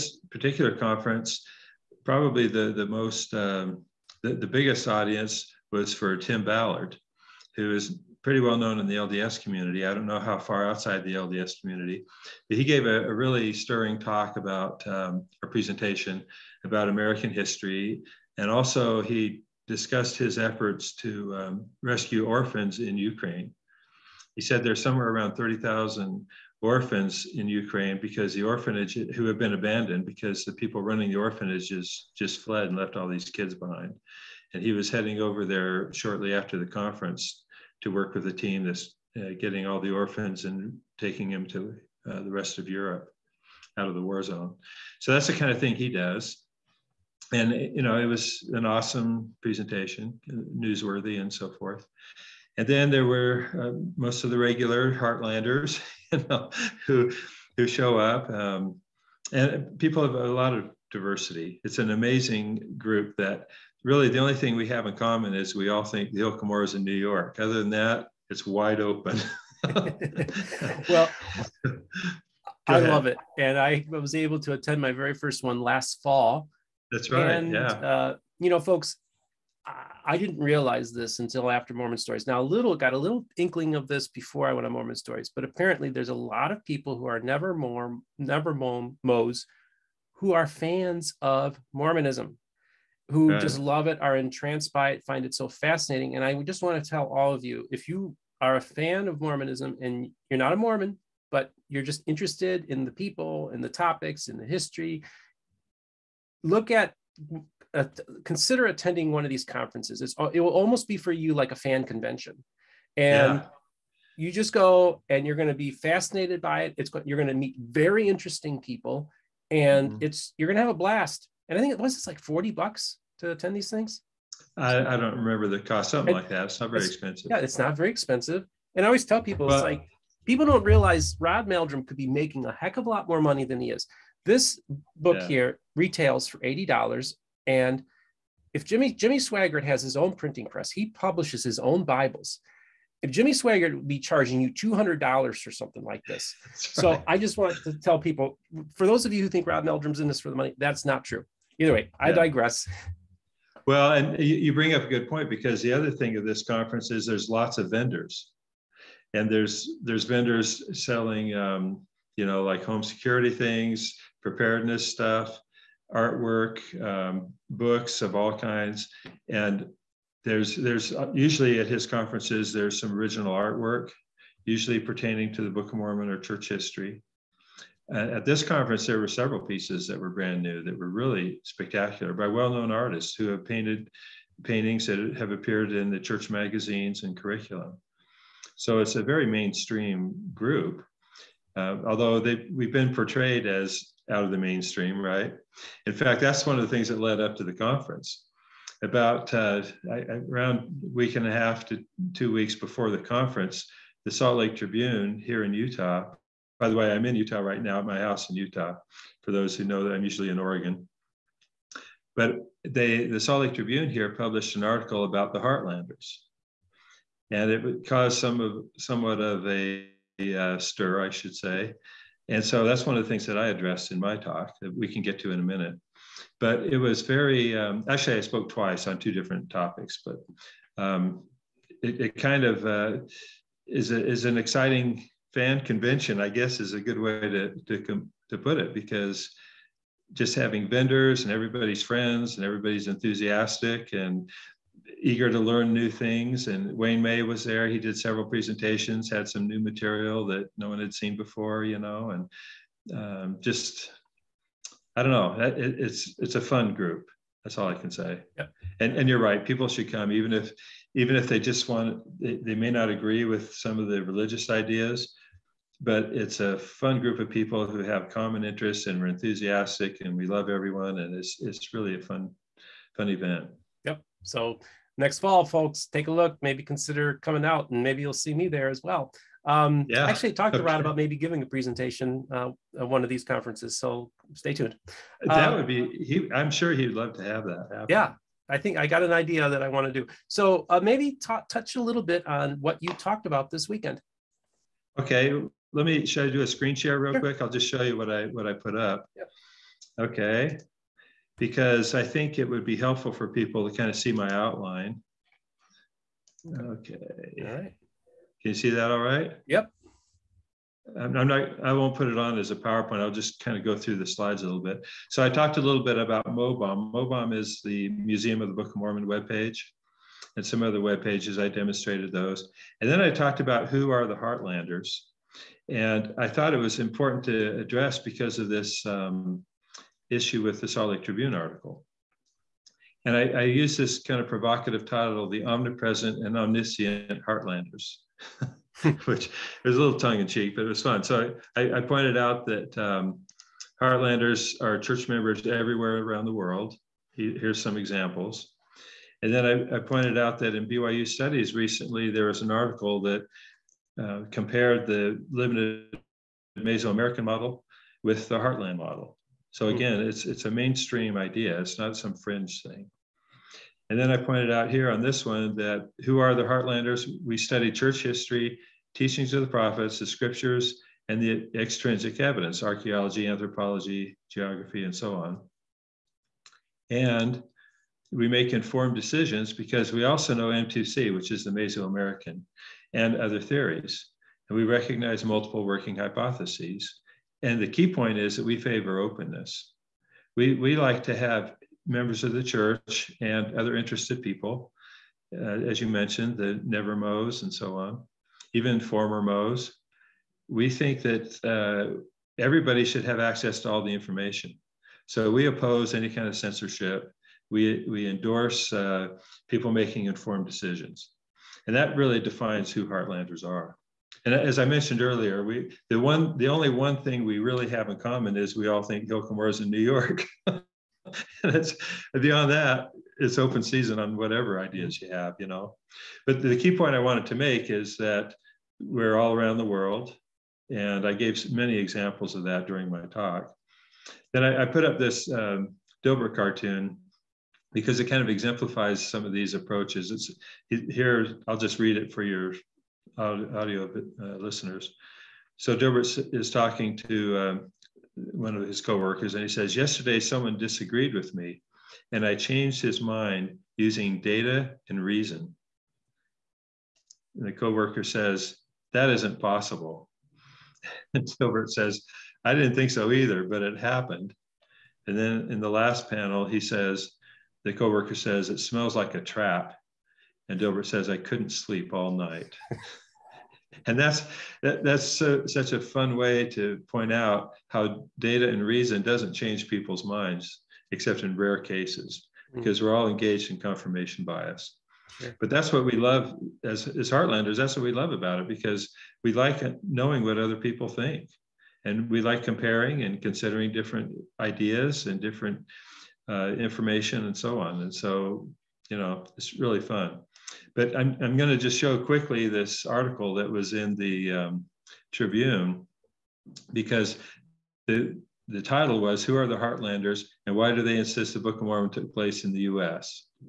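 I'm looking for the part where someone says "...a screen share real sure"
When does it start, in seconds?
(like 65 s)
296 s.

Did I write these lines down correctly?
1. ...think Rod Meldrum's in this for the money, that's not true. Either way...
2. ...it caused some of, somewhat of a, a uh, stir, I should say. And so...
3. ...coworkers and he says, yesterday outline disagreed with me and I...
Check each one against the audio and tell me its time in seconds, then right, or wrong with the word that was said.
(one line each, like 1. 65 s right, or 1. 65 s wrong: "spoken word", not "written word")
1. 149 s right
2. 217 s right
3. 448 s wrong: "someone", not "outline".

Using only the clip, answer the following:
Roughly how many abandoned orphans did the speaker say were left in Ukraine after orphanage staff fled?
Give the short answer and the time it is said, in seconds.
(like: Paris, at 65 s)
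30,000, at 25 s.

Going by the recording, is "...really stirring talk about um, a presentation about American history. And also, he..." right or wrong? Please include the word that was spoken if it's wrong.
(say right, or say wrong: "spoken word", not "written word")
right.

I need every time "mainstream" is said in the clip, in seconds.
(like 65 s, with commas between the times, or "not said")
189 s, 194 s, 360 s.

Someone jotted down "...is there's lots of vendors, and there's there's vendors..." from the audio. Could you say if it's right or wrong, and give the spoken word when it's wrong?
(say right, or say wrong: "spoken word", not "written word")
right.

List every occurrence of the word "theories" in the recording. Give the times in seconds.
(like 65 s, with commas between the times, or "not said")
383 s.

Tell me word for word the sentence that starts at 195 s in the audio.
In fact, that's one of the things that led up to the conference.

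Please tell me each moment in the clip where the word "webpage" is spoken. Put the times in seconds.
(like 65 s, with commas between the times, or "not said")
319 s.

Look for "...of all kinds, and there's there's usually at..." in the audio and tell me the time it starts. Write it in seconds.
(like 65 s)
168 s.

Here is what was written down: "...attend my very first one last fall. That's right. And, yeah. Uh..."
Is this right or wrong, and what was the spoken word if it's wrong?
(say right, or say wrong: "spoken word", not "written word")
right.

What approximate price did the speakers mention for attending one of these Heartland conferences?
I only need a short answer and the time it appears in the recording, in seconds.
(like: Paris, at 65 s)
$40, at 122 s.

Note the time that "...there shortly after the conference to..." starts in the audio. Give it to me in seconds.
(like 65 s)
35 s.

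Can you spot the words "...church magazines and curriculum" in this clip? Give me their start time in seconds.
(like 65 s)
185 s.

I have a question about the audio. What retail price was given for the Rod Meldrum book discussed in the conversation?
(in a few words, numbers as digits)
$80.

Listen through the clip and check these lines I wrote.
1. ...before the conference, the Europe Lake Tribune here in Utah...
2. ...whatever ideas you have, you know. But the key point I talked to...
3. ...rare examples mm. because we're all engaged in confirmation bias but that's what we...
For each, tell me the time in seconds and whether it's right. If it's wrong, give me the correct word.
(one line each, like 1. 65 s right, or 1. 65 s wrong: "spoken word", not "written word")
1. 202 s wrong: "Salt", not "Europe"
2. 424 s wrong: "wanted", not "talked"
3. 481 s wrong: "cases", not "examples".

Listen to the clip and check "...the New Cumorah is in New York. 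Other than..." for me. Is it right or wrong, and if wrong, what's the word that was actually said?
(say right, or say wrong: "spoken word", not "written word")
wrong: "Hill", not "New".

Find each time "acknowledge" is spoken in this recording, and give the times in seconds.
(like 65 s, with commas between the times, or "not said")
not said.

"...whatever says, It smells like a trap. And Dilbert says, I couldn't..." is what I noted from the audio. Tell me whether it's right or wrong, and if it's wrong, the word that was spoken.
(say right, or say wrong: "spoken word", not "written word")
wrong: "coworker", not "whatever".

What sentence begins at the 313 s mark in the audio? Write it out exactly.
I'll just kind of go through the slides a little bit.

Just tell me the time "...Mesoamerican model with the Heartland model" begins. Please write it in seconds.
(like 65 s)
356 s.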